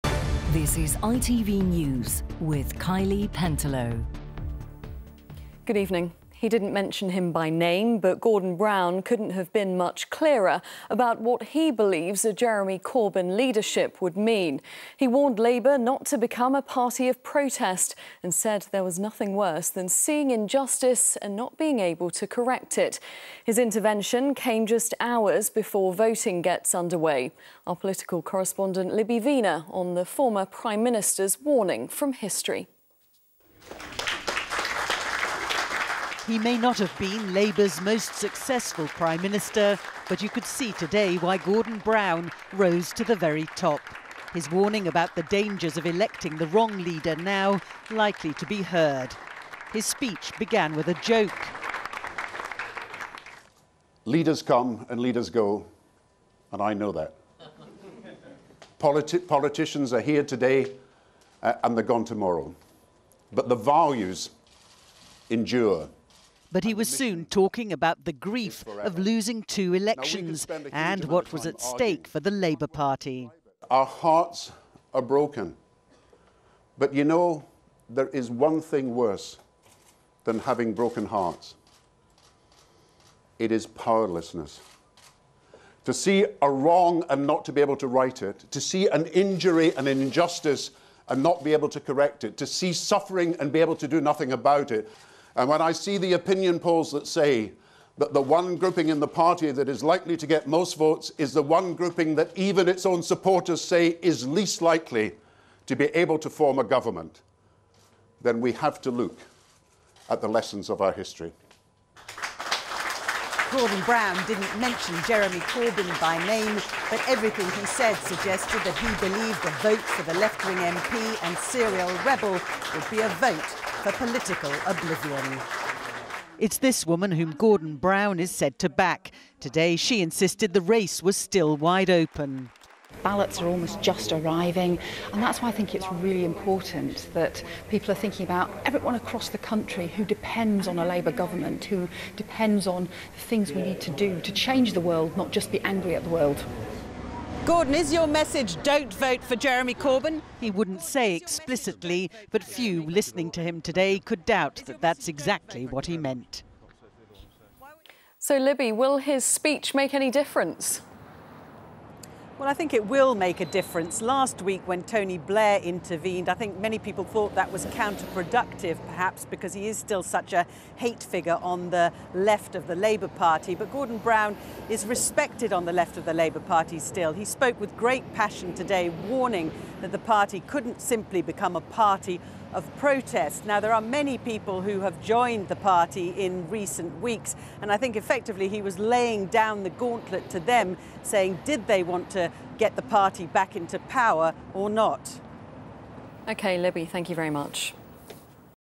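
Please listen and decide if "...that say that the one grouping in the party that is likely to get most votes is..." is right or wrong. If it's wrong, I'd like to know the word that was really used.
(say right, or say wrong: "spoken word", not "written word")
right.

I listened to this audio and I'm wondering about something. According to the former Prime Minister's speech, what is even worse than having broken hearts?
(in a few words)
Powerlessness.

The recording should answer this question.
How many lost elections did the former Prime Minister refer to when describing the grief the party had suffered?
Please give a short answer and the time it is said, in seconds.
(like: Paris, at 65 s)
2, at 69 s.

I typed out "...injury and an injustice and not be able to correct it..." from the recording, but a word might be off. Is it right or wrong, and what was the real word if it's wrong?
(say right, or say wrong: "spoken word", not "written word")
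right.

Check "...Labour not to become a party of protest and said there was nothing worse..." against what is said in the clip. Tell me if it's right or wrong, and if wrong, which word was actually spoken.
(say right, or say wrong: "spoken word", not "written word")
right.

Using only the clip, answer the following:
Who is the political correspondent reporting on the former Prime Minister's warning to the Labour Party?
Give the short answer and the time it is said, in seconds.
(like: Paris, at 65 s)
Libby Wiener, at 28 s.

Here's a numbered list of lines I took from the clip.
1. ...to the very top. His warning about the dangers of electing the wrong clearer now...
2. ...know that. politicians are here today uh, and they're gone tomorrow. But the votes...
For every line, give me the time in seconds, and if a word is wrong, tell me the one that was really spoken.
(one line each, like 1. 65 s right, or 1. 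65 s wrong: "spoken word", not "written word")
1. 42 s wrong: "leader", not "clearer"
2. 56 s wrong: "values", not "votes".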